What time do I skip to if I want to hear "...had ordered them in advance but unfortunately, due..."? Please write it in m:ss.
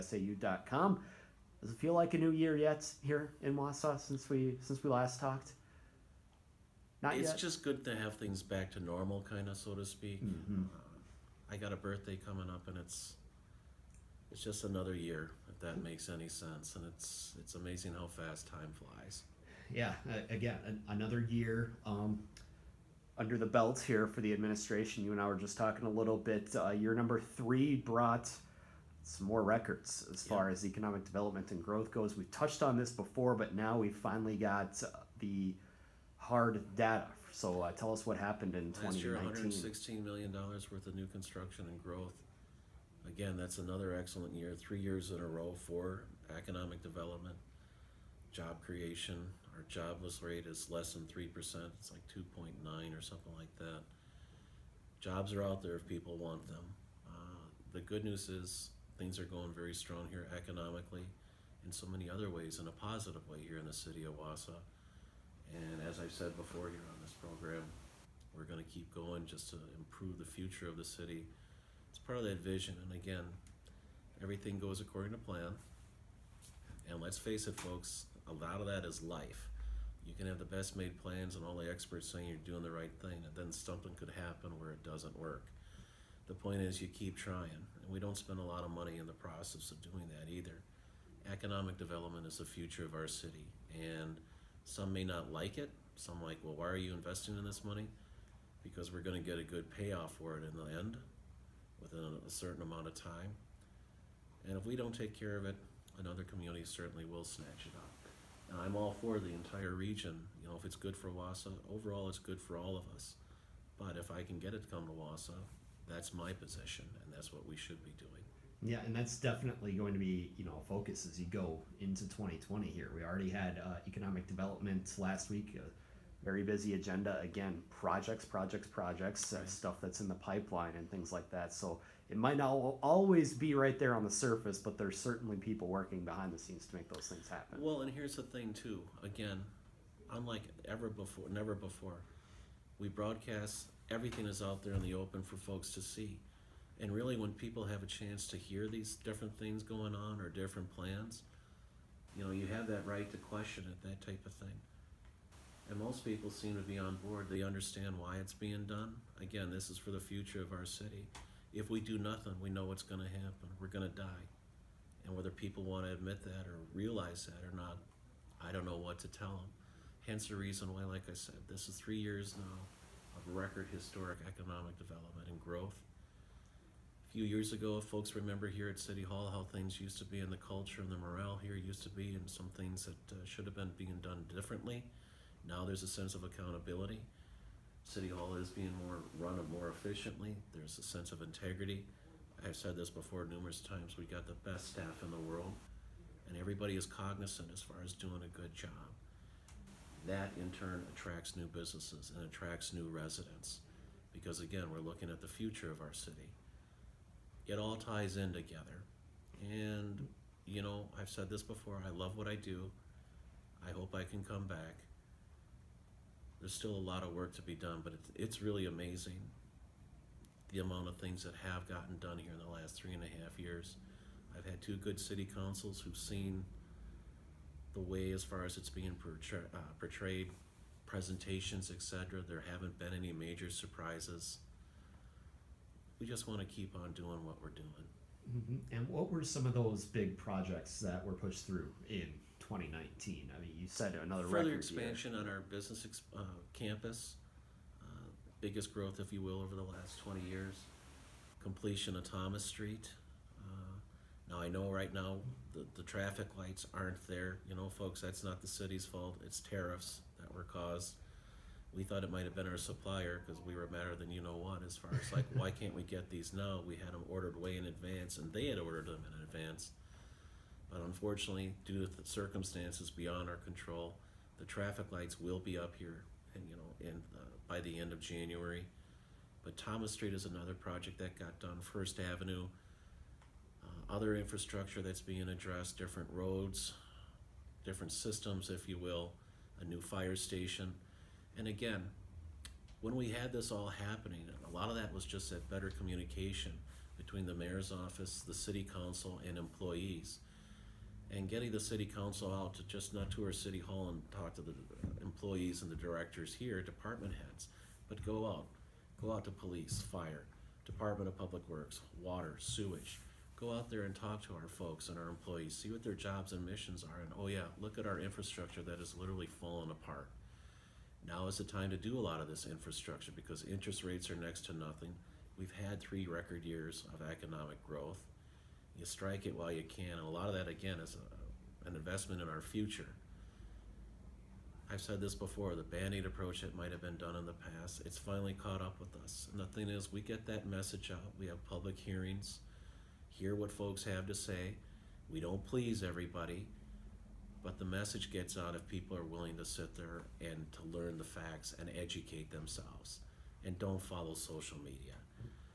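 4:28.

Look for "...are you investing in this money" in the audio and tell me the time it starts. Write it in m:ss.
1:36.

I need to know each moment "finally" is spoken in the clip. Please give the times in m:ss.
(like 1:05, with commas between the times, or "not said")
0:33, 5:37.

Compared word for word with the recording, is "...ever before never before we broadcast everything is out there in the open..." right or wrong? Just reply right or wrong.
right.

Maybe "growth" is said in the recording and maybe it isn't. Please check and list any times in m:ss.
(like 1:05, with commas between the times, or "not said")
0:31, 0:41, 2:55, 4:08, 5:27.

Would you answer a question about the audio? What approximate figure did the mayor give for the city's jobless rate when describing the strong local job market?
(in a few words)
2.9%.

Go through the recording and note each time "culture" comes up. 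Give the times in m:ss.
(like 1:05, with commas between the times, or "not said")
3:00.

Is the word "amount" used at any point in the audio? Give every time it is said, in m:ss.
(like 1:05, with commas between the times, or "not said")
1:42, 3:40.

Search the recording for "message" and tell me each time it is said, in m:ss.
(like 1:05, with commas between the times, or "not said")
5:40, 5:47.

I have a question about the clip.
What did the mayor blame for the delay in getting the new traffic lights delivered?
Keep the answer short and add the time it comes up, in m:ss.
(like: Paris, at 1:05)
Tariffs, at 4:19.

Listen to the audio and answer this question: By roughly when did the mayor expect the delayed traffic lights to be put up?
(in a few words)
End of January.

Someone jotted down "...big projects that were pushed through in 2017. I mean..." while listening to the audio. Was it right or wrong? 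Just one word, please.
wrong.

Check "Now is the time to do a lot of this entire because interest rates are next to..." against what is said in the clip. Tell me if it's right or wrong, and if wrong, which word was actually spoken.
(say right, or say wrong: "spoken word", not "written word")
wrong: "infrastructure", not "entire".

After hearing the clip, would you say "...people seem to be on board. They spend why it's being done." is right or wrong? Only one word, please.
wrong.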